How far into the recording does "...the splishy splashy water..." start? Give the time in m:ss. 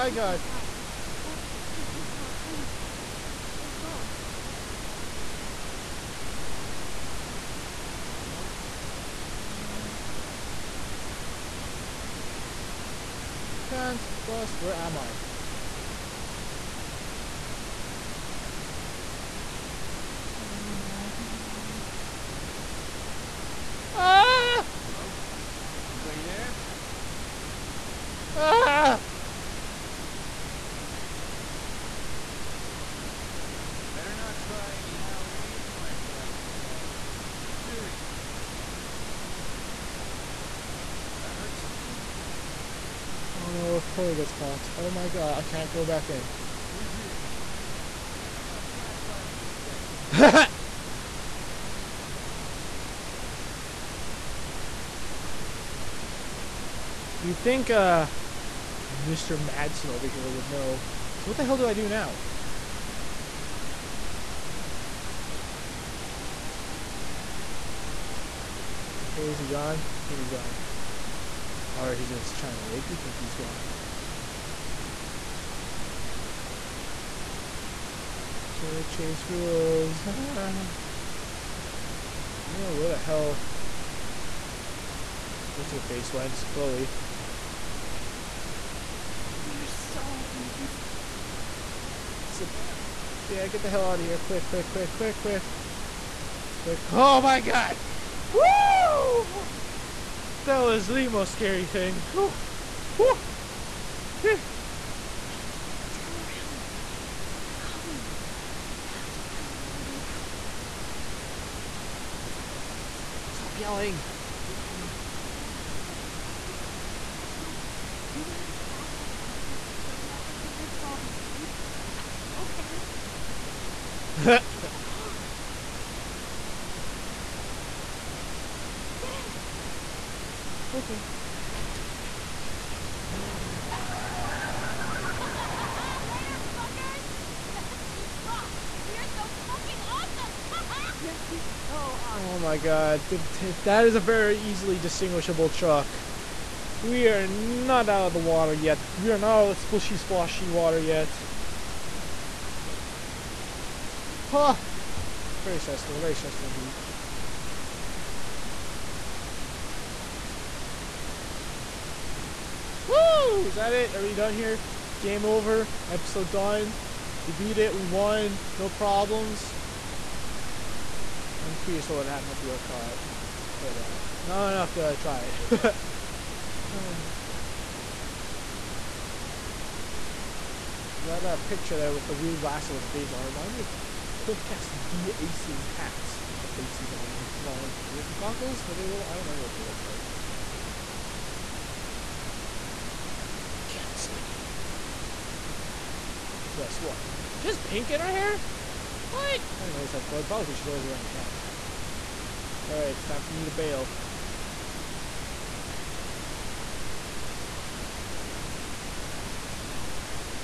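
2:29.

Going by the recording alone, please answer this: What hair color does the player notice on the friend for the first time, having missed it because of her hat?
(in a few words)
Pink.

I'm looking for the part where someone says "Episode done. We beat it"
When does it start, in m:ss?
2:45.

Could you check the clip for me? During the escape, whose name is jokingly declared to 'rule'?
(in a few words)
Victoria Chase.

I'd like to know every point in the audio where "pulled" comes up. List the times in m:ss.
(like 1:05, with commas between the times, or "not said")
not said.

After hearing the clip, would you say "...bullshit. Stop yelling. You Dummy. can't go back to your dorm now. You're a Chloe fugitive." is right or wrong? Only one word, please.
wrong.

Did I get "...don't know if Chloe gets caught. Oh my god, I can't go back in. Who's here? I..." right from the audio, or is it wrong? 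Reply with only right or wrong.
right.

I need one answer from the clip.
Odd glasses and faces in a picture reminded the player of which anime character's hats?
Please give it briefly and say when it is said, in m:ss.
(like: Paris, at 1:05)
Portgas D Ace, at 3:04.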